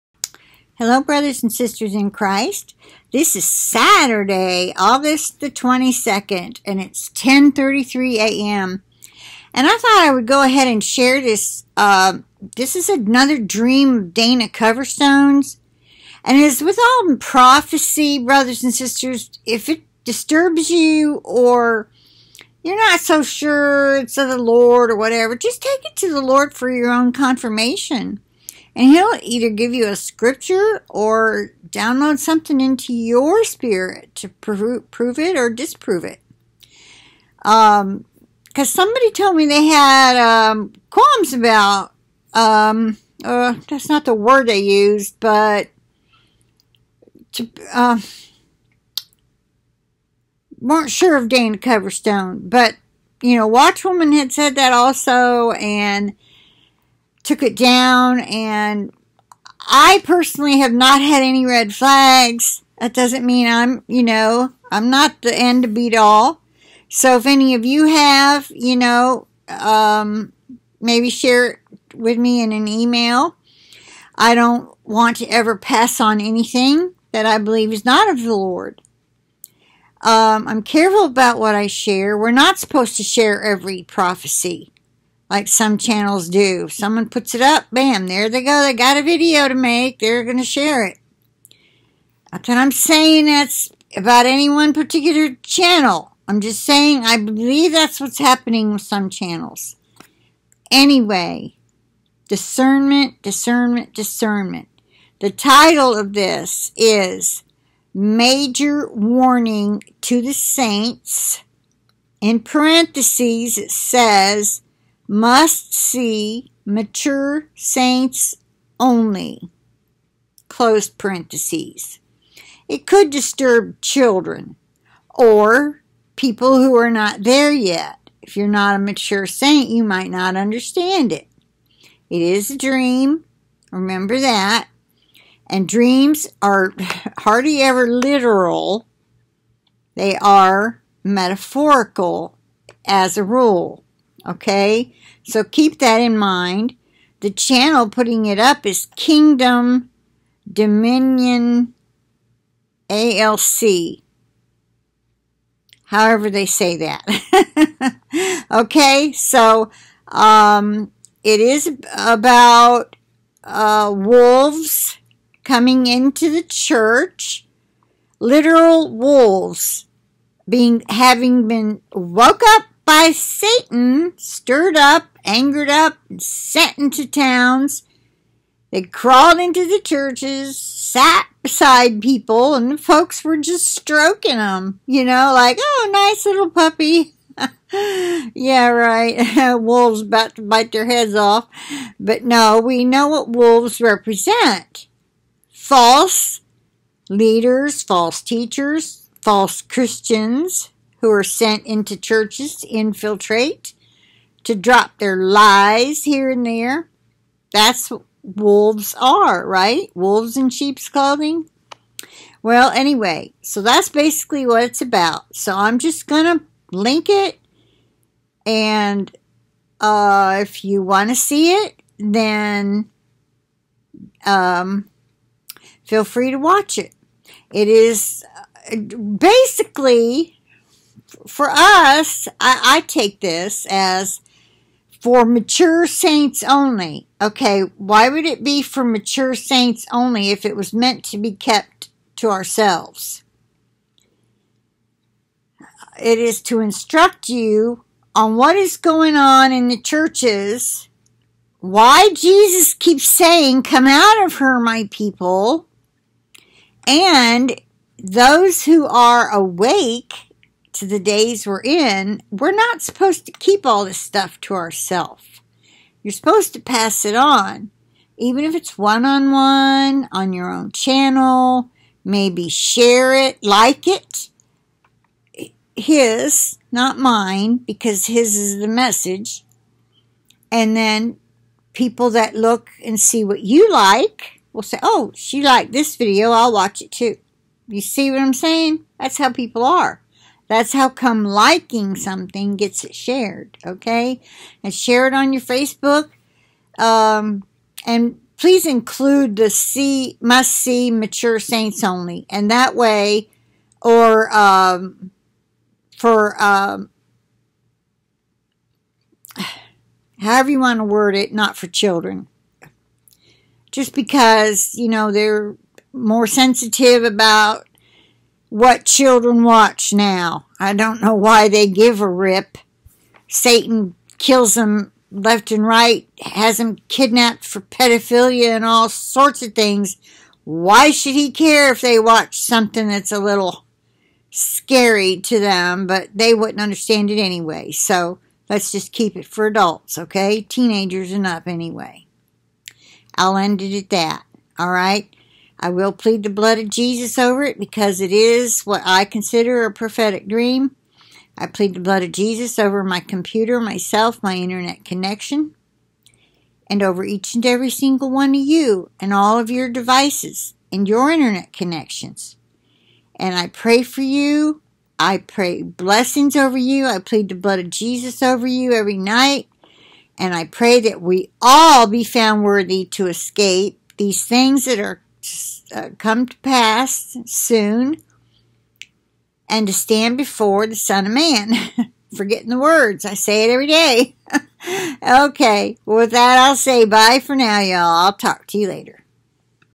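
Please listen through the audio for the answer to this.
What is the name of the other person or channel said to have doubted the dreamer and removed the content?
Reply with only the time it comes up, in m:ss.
0:53.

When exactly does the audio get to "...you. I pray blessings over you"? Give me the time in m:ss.
6:04.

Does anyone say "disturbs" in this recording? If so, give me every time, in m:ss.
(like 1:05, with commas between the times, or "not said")
0:20, 2:03.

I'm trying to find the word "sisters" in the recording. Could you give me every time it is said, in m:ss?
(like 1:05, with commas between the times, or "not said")
0:01, 0:18.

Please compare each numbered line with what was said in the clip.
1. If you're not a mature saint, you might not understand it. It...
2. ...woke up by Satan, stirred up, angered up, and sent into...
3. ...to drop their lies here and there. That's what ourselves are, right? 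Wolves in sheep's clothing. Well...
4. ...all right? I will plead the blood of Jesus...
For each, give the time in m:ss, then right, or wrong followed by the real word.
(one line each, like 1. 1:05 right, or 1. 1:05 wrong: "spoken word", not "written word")
1. 2:08 right
2. 2:51 right
3. 3:24 wrong: "wolves", not "ourselves"
4. 5:44 right.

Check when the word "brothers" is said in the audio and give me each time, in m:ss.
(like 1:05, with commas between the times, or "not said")
0:01, 0:18.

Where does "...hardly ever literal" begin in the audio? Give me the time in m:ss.
2:17.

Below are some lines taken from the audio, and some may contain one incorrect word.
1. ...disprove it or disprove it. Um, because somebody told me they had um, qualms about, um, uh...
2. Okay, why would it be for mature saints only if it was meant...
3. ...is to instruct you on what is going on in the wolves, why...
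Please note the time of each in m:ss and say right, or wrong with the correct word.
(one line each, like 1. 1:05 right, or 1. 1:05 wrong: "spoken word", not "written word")
1. 0:34 wrong: "prove", not "disprove"
2. 3:57 right
3. 4:06 wrong: "churches", not "wolves".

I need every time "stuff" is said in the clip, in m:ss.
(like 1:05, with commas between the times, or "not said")
4:23.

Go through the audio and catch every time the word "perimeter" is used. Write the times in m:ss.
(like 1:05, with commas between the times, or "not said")
not said.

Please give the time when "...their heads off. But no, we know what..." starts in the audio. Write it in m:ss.
3:10.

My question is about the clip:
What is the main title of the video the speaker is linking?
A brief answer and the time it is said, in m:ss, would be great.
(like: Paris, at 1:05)
Major Warning to the Saints, at 1:47.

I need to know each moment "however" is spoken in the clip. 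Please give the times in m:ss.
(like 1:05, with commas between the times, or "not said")
2:35, 5:10.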